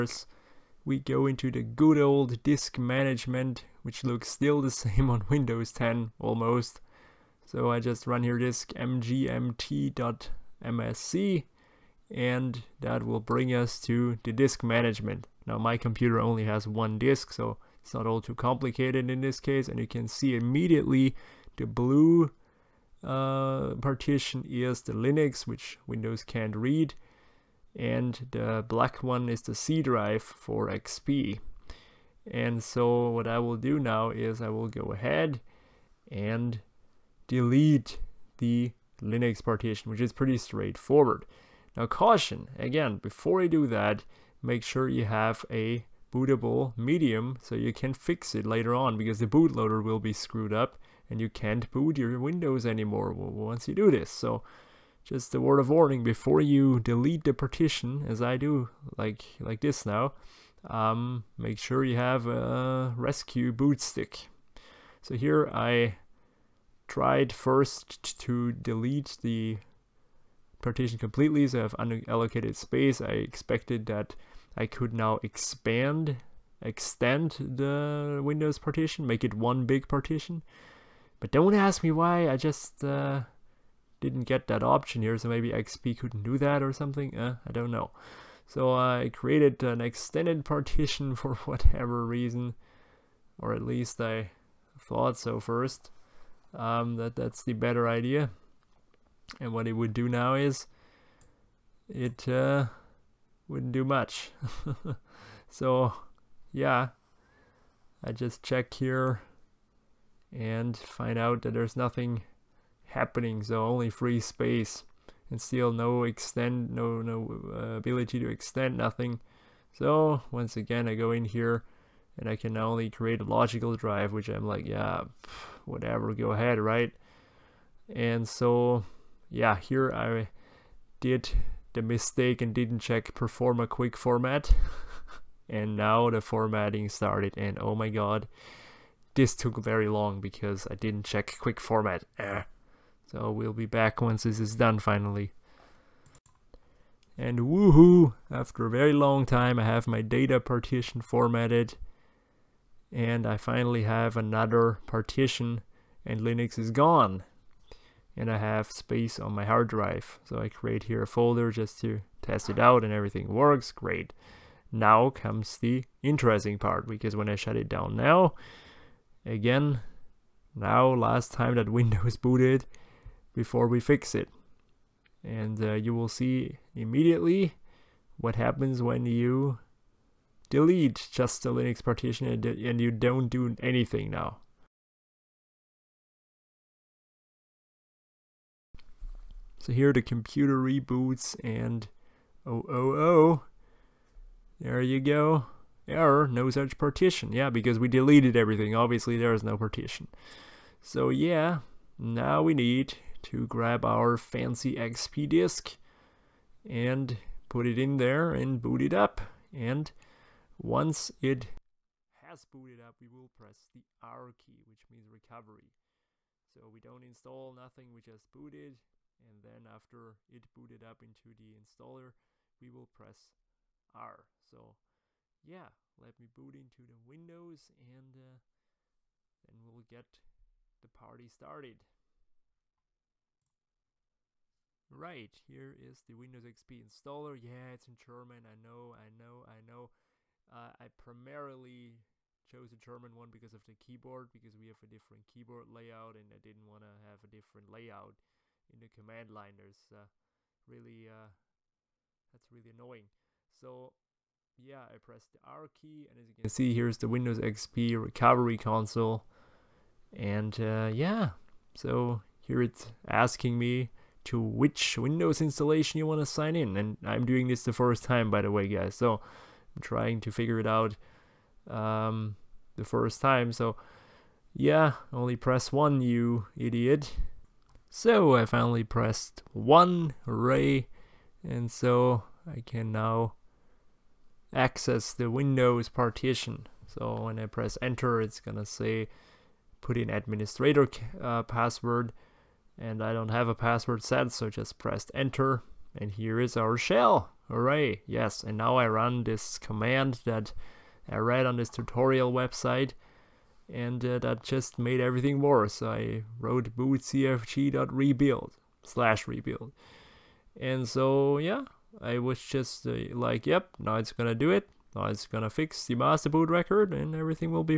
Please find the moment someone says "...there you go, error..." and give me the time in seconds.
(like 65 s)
194 s.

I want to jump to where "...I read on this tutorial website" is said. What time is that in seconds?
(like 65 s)
301 s.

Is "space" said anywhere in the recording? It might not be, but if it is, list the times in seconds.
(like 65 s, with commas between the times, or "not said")
72 s, 114 s, 158 s.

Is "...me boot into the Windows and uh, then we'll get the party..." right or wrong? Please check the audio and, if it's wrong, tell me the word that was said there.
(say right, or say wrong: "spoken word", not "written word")
right.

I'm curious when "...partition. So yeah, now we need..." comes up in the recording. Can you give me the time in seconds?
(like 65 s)
199 s.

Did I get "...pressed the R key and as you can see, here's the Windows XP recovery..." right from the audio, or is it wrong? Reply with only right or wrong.
right.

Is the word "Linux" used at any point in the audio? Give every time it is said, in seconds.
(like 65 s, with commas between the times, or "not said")
24 s, 38 s, 156 s, 181 s.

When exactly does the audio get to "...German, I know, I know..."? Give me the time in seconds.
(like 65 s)
237 s.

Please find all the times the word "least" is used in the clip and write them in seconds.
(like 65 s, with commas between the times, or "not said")
93 s.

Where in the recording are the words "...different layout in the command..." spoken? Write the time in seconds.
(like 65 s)
247 s.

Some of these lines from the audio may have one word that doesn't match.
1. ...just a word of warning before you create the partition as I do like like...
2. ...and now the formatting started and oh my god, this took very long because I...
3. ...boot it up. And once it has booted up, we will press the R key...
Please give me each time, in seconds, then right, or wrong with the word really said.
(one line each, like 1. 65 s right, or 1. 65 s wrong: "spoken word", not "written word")
1. 55 s wrong: "delete", not "create"
2. 135 s right
3. 208 s right.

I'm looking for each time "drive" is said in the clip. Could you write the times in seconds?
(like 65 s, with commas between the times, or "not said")
29 s, 123 s, 159 s.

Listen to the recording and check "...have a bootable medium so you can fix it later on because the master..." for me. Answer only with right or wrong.
wrong.